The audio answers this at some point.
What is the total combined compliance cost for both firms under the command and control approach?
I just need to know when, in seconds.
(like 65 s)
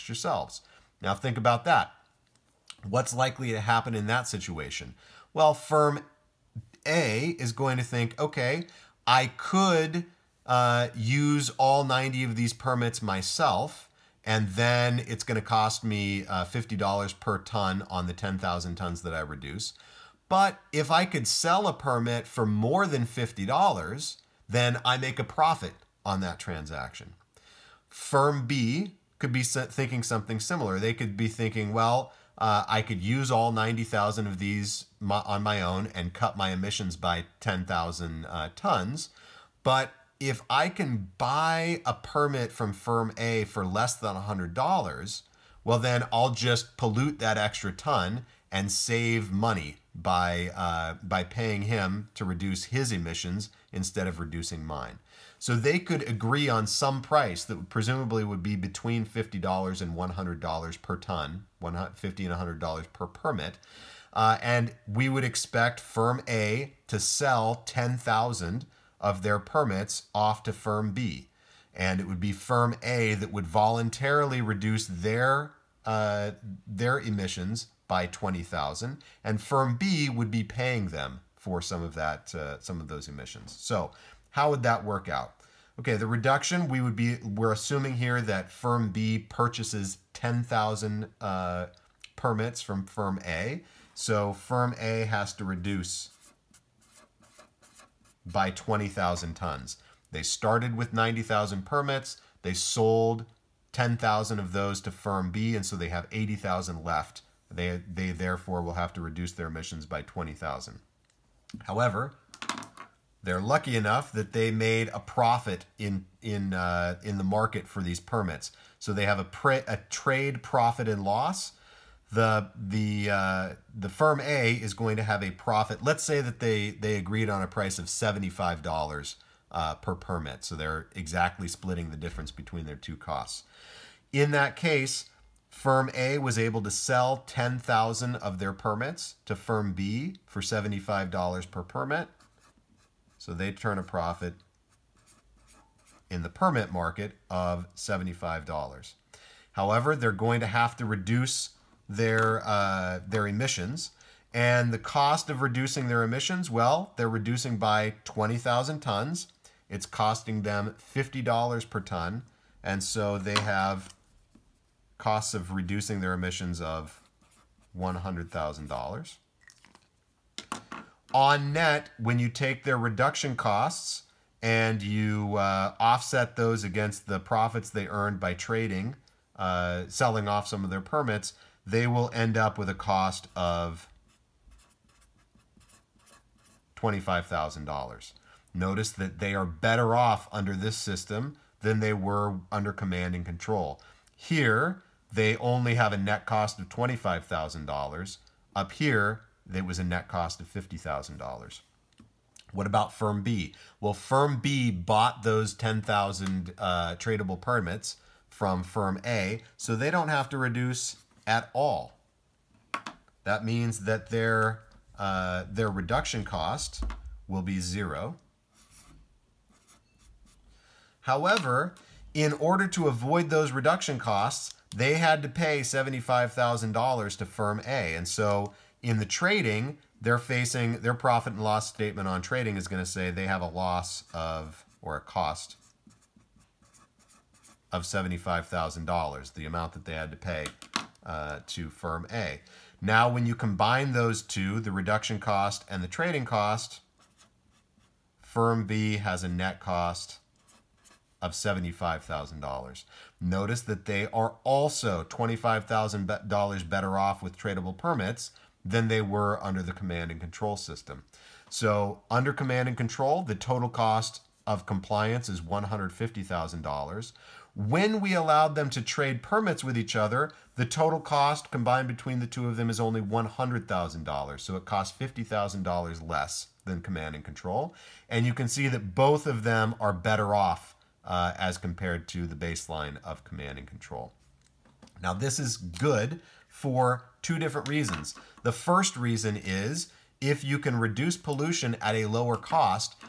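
265 s.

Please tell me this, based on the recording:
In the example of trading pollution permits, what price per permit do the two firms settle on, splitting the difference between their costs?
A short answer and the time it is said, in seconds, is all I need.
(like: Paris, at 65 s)
$75, at 127 s.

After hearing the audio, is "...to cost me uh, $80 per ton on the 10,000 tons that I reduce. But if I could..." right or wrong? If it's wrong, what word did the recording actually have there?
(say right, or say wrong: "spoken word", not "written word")
wrong: "50", not "80".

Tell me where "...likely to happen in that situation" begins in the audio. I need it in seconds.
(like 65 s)
3 s.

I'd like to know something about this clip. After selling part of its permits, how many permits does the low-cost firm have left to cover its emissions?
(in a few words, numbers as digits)
80,000.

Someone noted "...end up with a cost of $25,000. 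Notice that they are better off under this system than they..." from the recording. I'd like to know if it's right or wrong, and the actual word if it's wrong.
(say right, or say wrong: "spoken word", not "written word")
right.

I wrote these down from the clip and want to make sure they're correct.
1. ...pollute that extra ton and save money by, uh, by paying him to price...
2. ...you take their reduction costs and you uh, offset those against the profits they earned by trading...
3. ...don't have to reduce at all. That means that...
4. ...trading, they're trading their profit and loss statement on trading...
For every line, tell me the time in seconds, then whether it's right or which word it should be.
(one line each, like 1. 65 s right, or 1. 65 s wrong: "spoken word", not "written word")
1. 46 s wrong: "reduce", not "price"
2. 172 s right
3. 209 s right
4. 229 s wrong: "facing", not "trading".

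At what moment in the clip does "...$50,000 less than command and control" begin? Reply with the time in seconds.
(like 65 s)
274 s.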